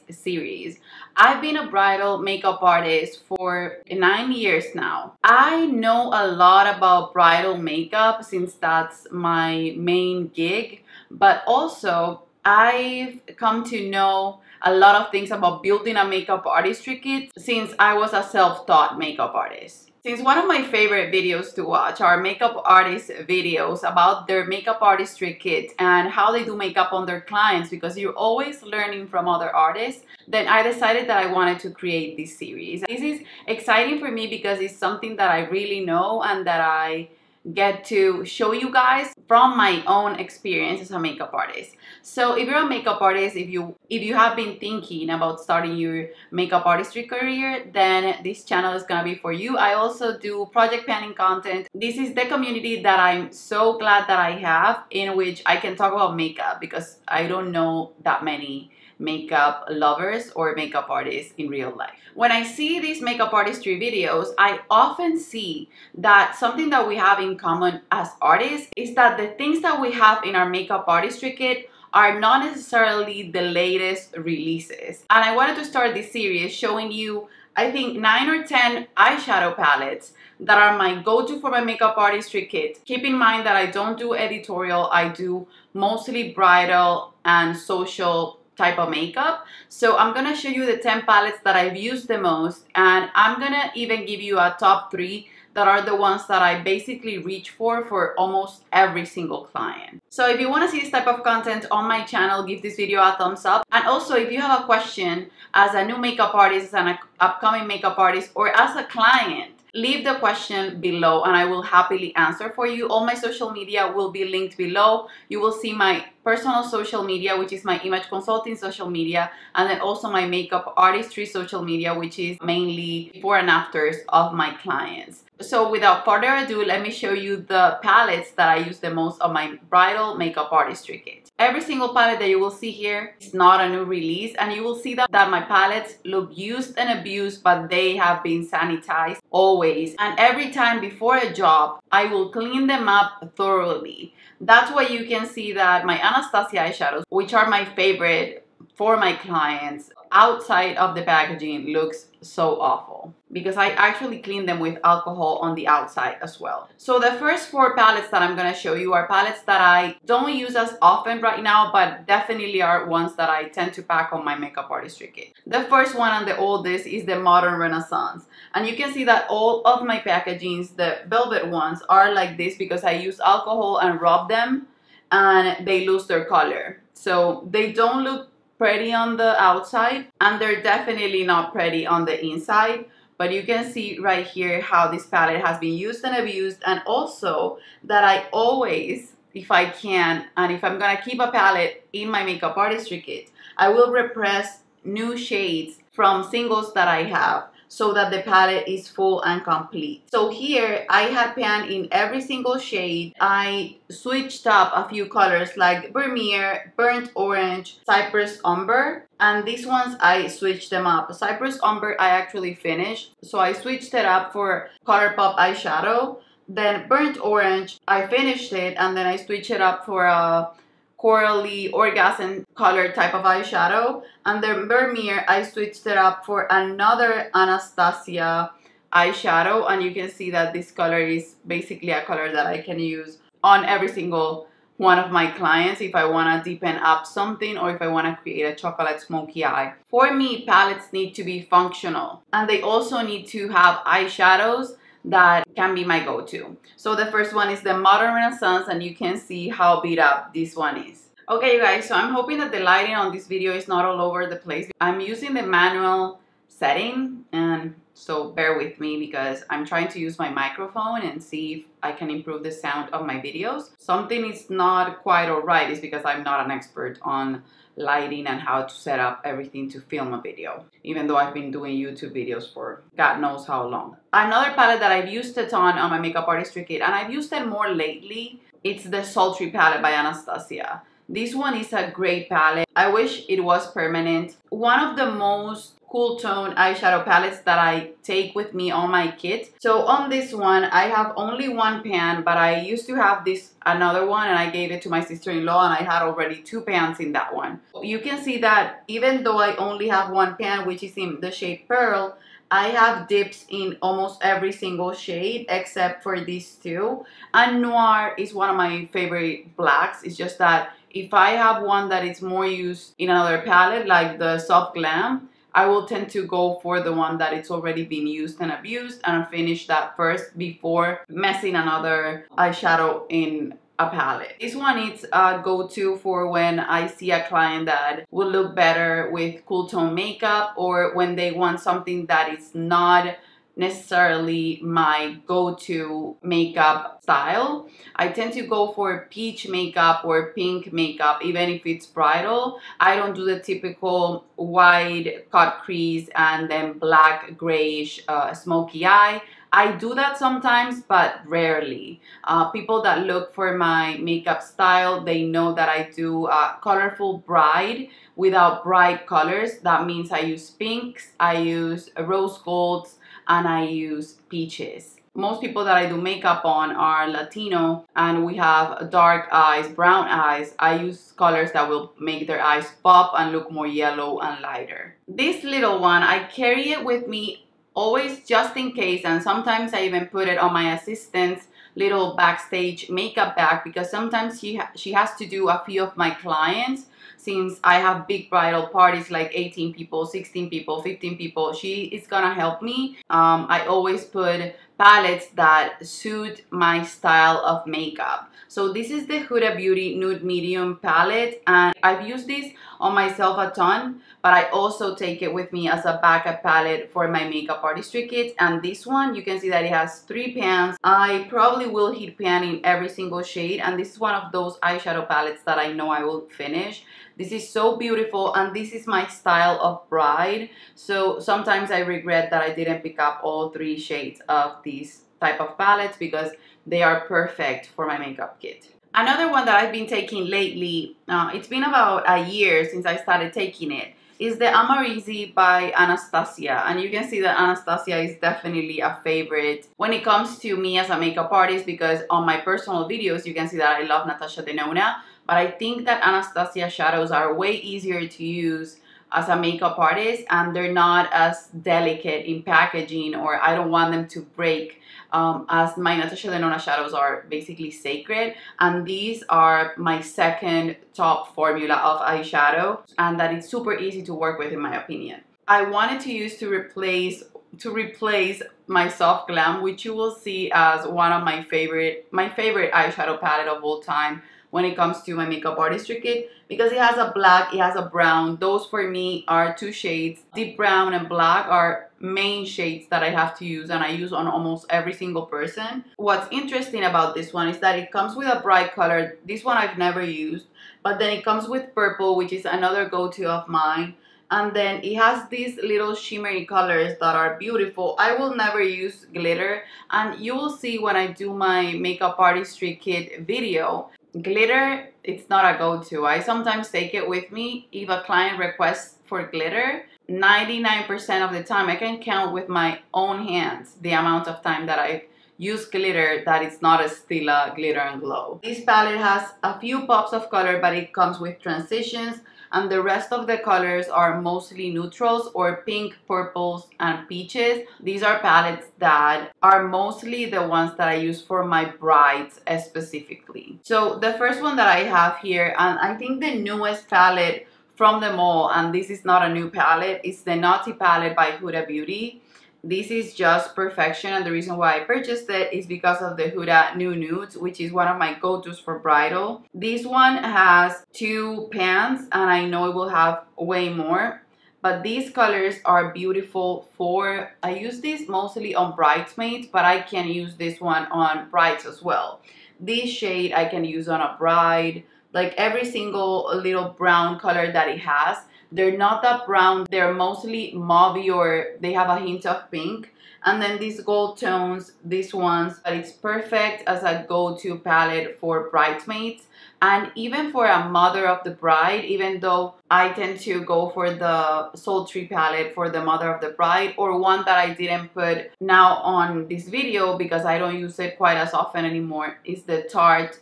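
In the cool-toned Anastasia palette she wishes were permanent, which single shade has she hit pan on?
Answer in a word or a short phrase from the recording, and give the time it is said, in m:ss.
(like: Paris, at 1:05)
Pearl, at 5:01.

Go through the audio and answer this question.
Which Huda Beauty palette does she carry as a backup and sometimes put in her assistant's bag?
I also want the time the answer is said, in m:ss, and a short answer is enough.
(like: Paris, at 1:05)
Nude Medium, at 6:39.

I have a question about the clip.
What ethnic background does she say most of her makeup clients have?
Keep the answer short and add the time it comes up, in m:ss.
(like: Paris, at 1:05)
Latino, at 6:07.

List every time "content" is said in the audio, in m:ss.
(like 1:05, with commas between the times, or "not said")
0:51, 1:41.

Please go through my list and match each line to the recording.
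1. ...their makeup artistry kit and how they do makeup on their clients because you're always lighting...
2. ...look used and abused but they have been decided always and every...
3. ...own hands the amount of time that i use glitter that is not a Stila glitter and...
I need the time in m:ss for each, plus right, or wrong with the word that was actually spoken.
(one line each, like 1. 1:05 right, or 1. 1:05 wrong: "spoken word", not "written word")
1. 0:24 wrong: "learning", not "lighting"
2. 2:16 wrong: "sanitized", not "decided"
3. 8:32 right.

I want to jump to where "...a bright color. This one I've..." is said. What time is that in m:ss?
8:08.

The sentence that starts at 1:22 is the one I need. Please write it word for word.
Keep in mind that I don't do editorial, I do mostly bridal and social type of makeup.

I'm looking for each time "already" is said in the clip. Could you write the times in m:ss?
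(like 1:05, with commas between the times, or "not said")
4:56, 5:17.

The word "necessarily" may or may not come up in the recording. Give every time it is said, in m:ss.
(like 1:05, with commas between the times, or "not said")
1:12, 5:33.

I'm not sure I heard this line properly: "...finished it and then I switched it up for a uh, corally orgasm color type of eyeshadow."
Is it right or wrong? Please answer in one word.
right.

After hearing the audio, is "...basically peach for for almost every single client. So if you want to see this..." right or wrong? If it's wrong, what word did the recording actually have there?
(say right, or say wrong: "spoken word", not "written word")
wrong: "reach", not "peach".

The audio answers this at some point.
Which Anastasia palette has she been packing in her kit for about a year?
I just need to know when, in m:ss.
7:14.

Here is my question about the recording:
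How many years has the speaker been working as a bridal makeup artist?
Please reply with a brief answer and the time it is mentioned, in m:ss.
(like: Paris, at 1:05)
9, at 0:03.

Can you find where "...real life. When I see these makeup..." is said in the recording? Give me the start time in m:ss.
1:01.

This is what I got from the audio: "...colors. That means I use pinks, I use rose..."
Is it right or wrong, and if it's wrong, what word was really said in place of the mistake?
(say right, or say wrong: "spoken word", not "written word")
right.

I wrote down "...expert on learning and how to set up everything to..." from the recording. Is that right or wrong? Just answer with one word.
wrong.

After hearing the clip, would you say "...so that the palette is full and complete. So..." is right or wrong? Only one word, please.
right.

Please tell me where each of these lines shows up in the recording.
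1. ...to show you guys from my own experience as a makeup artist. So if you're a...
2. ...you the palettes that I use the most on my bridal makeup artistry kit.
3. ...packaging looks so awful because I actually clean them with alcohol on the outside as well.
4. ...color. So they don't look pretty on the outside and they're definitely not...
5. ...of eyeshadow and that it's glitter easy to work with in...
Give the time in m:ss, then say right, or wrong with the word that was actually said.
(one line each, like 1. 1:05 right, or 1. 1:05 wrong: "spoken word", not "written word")
1. 0:37 right
2. 2:07 right
3. 2:31 right
4. 2:56 right
5. 7:41 wrong: "super", not "glitter".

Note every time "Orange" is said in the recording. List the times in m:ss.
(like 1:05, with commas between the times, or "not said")
3:27, 3:37.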